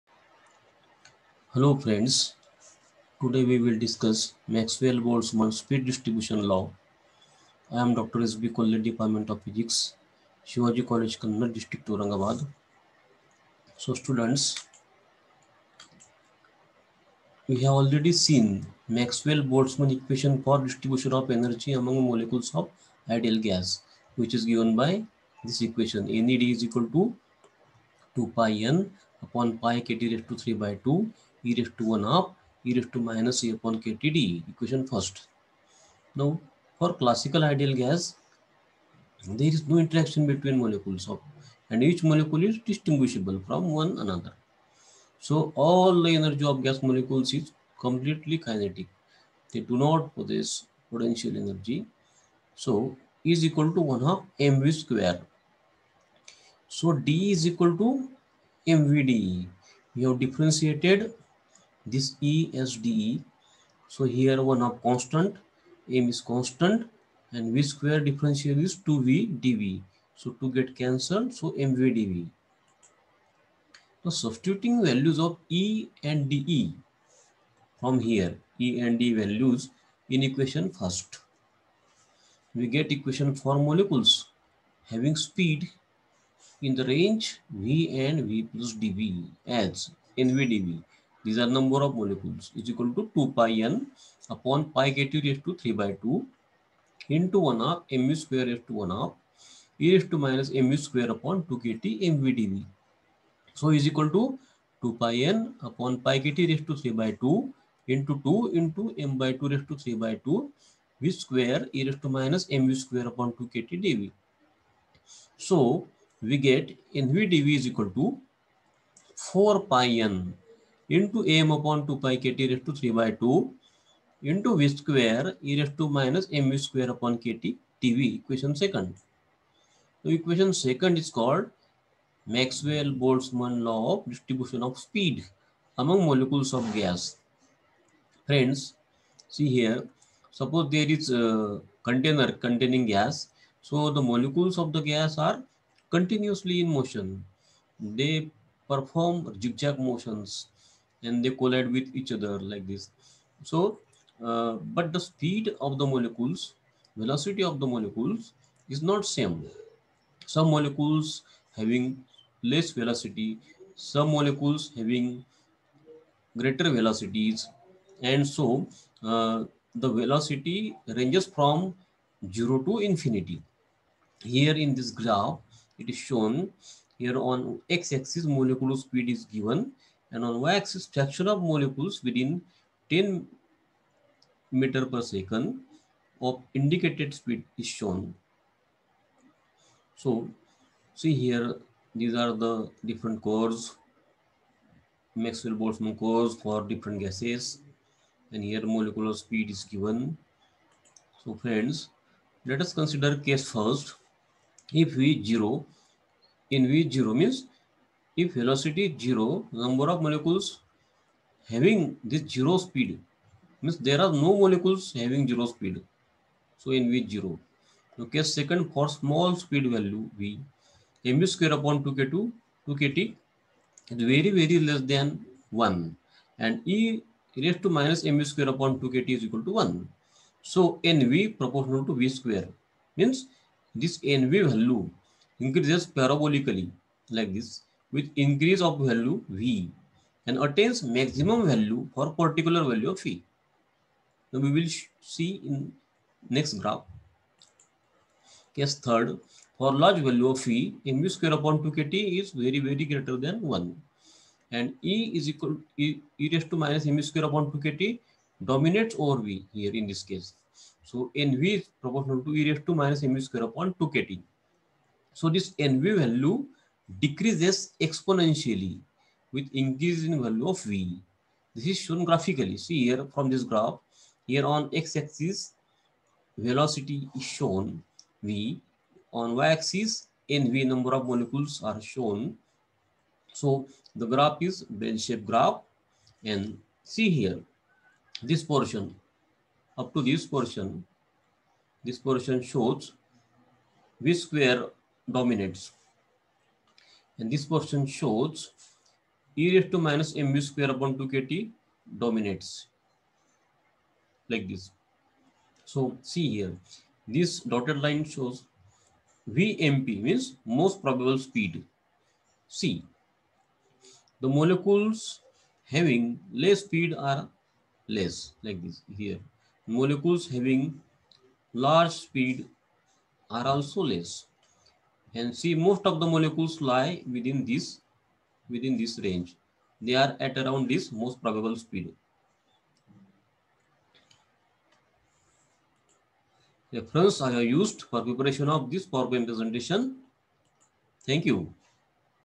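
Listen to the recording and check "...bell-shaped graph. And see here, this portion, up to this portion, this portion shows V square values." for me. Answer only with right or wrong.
wrong.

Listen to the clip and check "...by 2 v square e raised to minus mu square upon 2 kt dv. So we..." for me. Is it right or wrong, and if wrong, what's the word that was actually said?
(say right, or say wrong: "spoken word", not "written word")
right.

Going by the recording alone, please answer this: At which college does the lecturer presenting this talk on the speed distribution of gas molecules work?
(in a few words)
Shivaji College.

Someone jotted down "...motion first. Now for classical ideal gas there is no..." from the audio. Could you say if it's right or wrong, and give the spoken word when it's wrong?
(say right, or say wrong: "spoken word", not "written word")
wrong: "equation", not "motion".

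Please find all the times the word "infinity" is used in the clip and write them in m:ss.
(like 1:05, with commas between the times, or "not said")
2:52.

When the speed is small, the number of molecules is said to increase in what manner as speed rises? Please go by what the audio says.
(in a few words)
parabolically.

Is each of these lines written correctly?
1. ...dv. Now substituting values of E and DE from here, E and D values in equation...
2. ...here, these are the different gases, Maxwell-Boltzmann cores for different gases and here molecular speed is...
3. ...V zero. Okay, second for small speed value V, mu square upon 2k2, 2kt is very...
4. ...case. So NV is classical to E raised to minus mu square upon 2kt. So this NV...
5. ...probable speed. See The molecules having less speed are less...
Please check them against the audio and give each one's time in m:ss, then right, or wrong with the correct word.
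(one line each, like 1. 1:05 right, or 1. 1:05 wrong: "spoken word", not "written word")
1. 1:11 right
2. 3:11 wrong: "cores", not "gases"
3. 3:36 right
4. 4:20 wrong: "proportional", not "classical"
5. 5:10 right.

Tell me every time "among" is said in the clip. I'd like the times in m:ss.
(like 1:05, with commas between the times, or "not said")
0:21, 2:15.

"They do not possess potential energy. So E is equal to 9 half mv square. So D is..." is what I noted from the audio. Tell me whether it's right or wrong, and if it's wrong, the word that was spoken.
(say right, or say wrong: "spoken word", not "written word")
wrong: "1", not "9".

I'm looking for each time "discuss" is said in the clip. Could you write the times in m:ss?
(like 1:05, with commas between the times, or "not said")
0:03.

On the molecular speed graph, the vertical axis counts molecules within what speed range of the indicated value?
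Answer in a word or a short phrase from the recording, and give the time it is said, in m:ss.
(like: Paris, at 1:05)
10, at 3:02.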